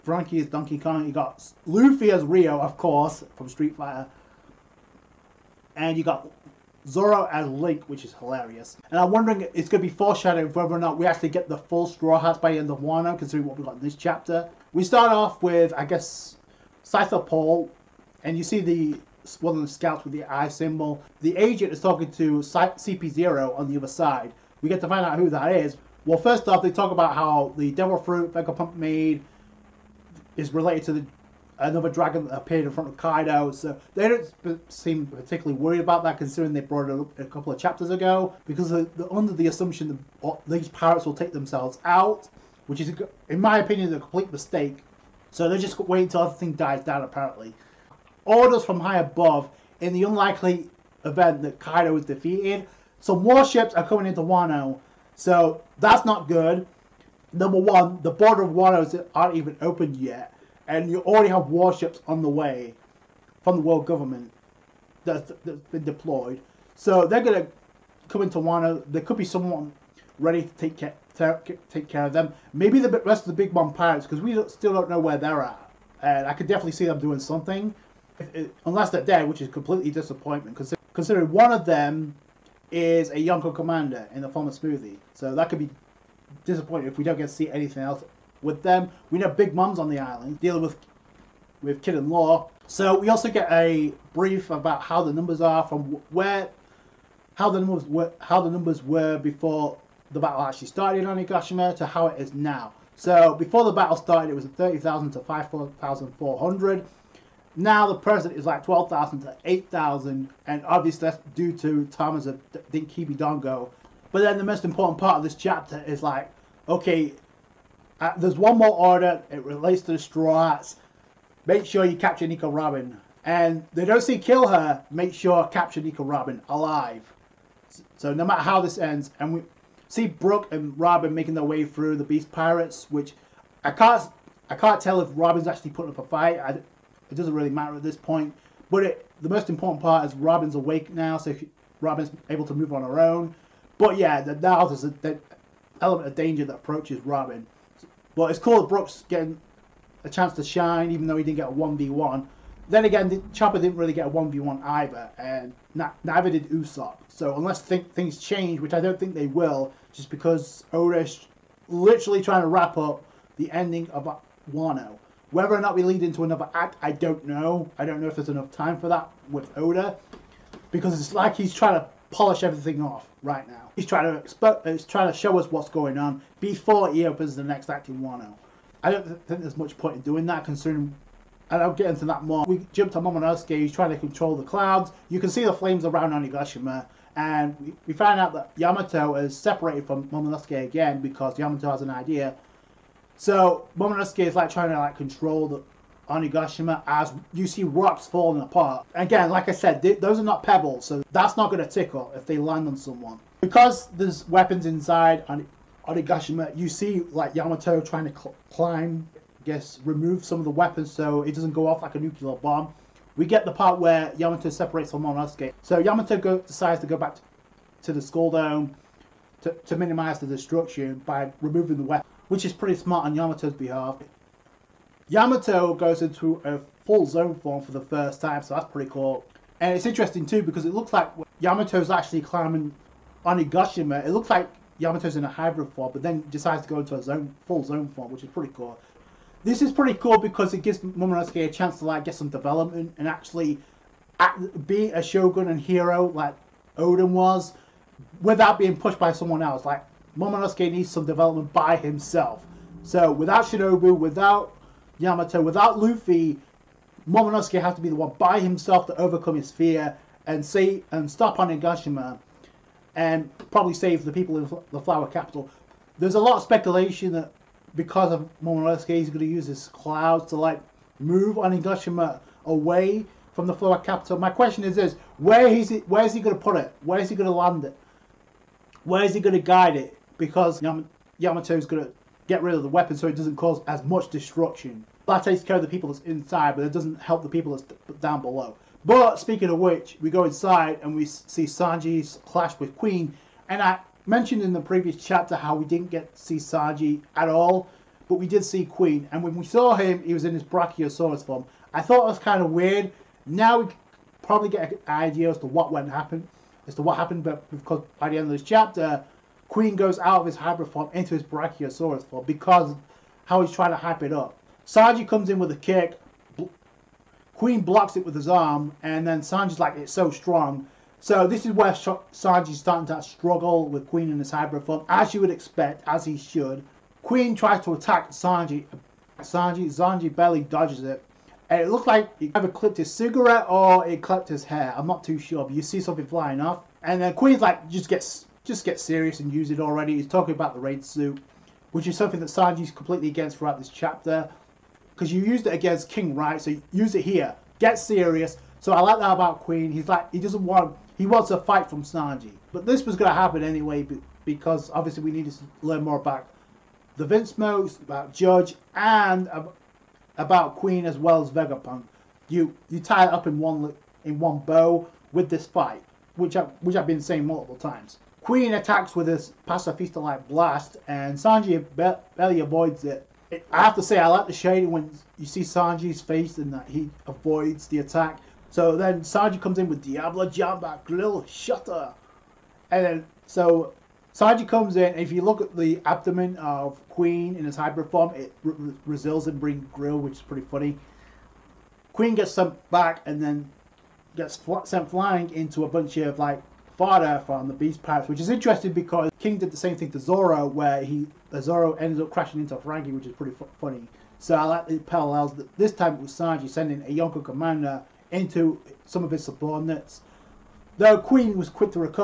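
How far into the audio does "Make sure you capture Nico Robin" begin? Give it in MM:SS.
02:01.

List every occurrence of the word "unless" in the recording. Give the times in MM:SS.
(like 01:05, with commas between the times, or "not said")
01:18, 02:37.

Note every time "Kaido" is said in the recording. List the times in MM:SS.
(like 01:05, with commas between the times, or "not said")
00:32, 00:51.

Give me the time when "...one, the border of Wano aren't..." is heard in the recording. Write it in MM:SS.
00:57.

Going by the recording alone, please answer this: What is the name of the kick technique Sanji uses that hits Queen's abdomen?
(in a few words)
Diable Jambe Grill Shutter.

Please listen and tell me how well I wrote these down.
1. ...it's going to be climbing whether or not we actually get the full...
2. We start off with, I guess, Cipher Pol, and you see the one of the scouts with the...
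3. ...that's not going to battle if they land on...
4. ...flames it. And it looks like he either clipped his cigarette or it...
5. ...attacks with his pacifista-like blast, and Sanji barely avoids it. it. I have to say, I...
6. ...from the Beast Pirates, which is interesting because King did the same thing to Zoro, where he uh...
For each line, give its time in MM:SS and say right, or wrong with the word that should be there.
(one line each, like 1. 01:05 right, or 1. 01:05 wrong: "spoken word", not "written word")
1. 00:09 wrong: "foreshadowing", not "climbing"
2. 00:14 right
3. 03:21 wrong: "tickle", not "battle"
4. 05:30 wrong: "dodges", not "flames"
5. 06:08 right
6. 06:37 right.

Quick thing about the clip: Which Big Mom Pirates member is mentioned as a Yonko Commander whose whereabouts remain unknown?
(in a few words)
Smoothie.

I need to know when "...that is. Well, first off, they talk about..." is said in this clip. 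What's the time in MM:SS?
00:25.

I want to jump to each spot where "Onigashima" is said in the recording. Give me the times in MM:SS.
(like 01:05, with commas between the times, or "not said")
03:06, 03:16, 03:25, 03:53, 04:21, 04:31.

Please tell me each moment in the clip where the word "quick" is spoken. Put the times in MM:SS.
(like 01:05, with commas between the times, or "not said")
06:51.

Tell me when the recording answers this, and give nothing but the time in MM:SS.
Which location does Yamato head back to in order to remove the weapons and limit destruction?
03:38.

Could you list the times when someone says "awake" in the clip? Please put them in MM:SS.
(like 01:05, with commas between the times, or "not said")
02:20.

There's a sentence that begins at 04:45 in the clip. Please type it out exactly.
That takes care of the people that's inside, but it doesn't help the people that's down below.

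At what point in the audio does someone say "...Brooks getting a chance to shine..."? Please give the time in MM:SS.
02:28.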